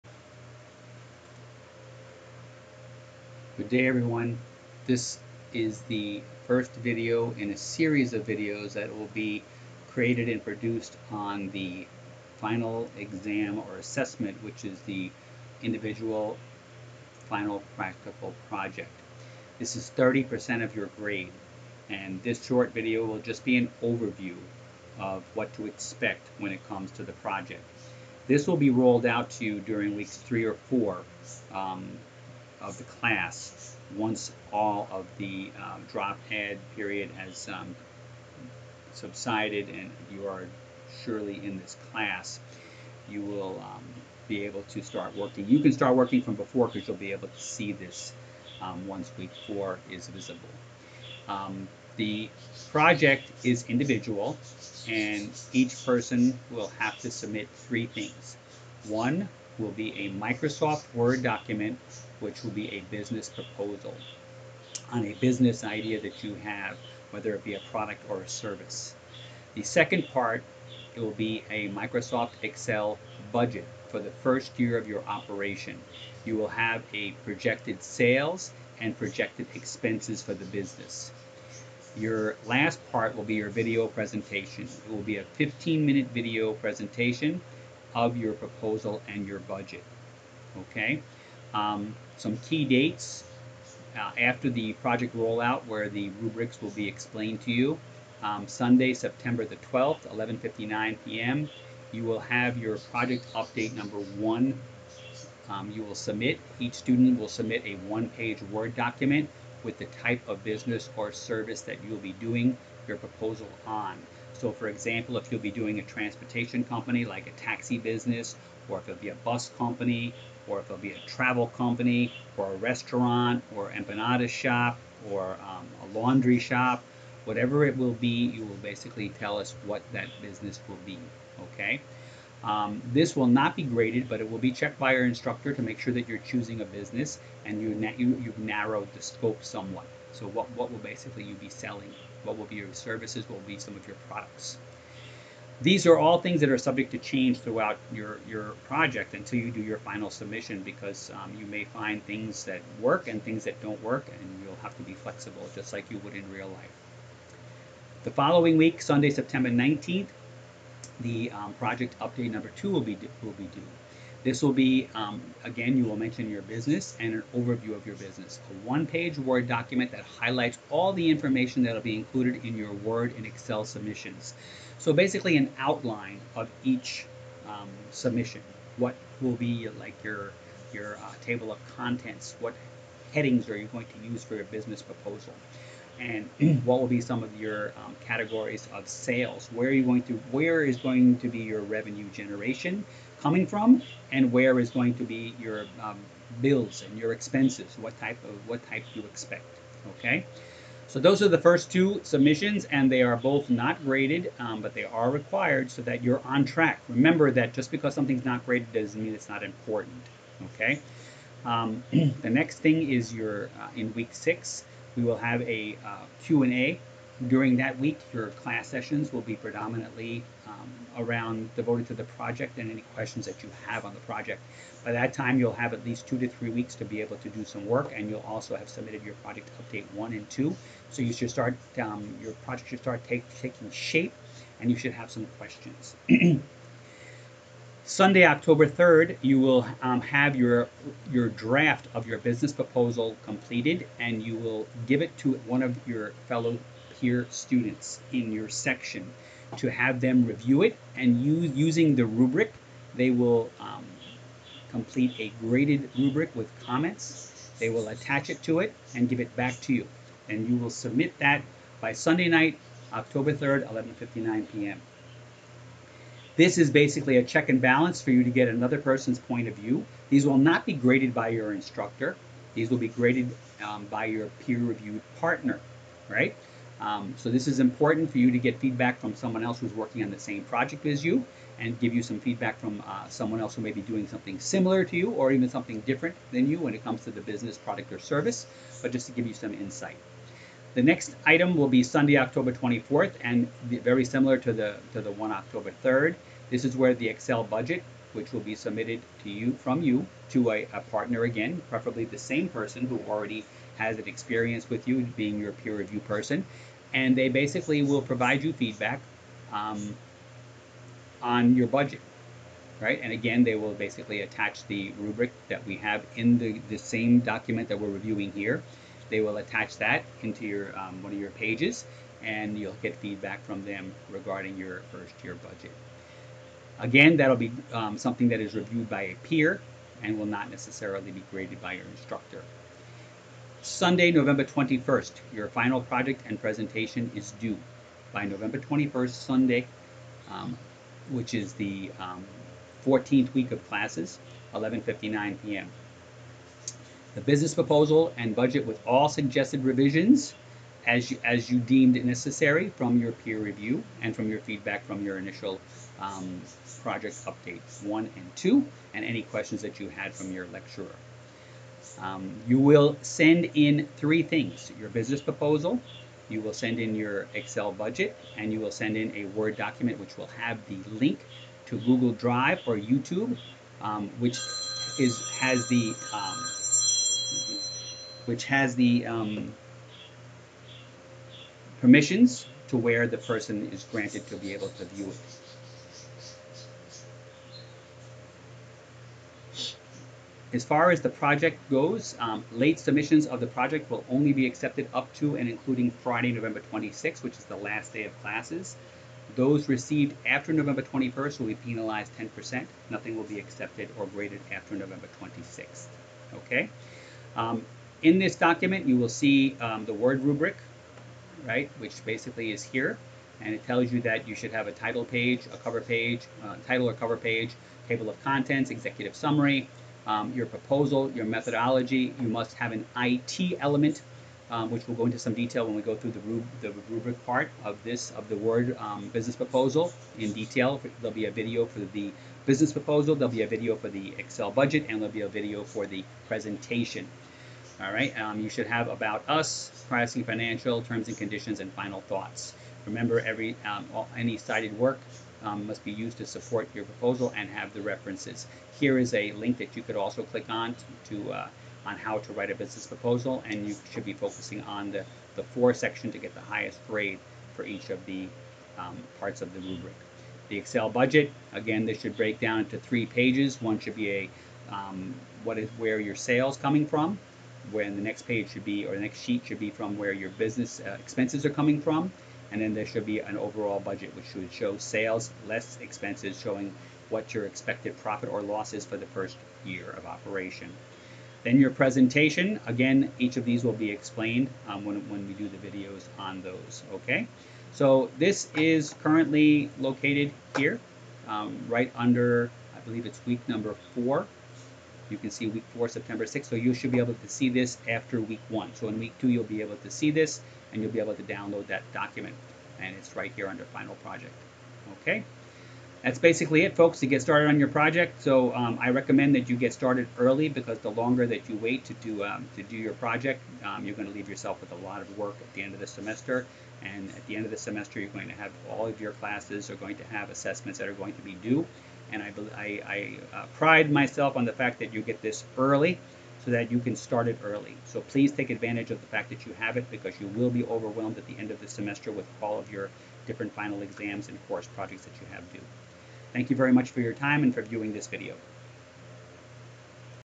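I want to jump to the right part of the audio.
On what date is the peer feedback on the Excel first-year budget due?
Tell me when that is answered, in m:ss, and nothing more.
4:51.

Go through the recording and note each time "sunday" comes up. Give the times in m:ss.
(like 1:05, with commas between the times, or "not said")
1:38, 2:38, 3:57, 4:21, 4:51, 5:33, 5:39.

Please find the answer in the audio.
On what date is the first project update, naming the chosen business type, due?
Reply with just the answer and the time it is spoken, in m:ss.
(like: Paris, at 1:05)
September 12th, at 1:38.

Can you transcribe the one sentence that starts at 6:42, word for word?
Nothing will be accepted or graded after November 26th.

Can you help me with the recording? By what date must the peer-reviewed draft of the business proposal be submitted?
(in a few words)
October 3rd.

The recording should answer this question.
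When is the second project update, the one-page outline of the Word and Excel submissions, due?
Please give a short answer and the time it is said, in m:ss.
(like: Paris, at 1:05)
September 19th, at 2:38.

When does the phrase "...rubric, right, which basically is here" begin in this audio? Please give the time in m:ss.
6:50.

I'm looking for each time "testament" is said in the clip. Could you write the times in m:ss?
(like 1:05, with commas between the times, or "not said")
not said.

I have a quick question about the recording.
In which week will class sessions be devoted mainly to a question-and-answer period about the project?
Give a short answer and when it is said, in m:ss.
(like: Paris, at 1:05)
Week 6, at 3:33.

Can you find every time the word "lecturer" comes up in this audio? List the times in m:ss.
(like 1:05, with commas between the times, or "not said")
6:00.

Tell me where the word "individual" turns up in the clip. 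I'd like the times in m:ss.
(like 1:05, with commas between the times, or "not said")
0:15, 0:53.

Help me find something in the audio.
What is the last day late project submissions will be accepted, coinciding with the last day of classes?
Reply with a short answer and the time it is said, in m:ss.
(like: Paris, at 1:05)
November 26th, at 6:35.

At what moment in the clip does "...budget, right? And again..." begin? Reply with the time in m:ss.
5:11.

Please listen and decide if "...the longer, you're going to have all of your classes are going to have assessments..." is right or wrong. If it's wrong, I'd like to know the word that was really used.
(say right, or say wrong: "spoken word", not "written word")
wrong: "semester", not "longer".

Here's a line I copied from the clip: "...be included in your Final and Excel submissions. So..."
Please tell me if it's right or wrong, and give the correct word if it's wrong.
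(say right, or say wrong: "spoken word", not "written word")
wrong: "Word", not "Final".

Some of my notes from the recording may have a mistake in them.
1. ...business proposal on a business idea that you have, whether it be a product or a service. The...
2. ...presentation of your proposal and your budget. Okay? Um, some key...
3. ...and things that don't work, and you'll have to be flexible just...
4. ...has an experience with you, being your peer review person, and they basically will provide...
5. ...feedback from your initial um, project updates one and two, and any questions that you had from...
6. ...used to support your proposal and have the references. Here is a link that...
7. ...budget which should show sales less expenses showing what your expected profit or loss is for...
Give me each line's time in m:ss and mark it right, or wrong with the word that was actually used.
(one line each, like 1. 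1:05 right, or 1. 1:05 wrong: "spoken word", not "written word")
1. 1:02 right
2. 1:26 right
3. 2:33 right
4. 5:03 right
5. 5:54 right
6. 7:25 right
7. 7:53 right.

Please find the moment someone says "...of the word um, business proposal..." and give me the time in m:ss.
7:08.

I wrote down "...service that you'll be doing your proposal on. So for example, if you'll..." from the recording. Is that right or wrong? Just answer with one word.
right.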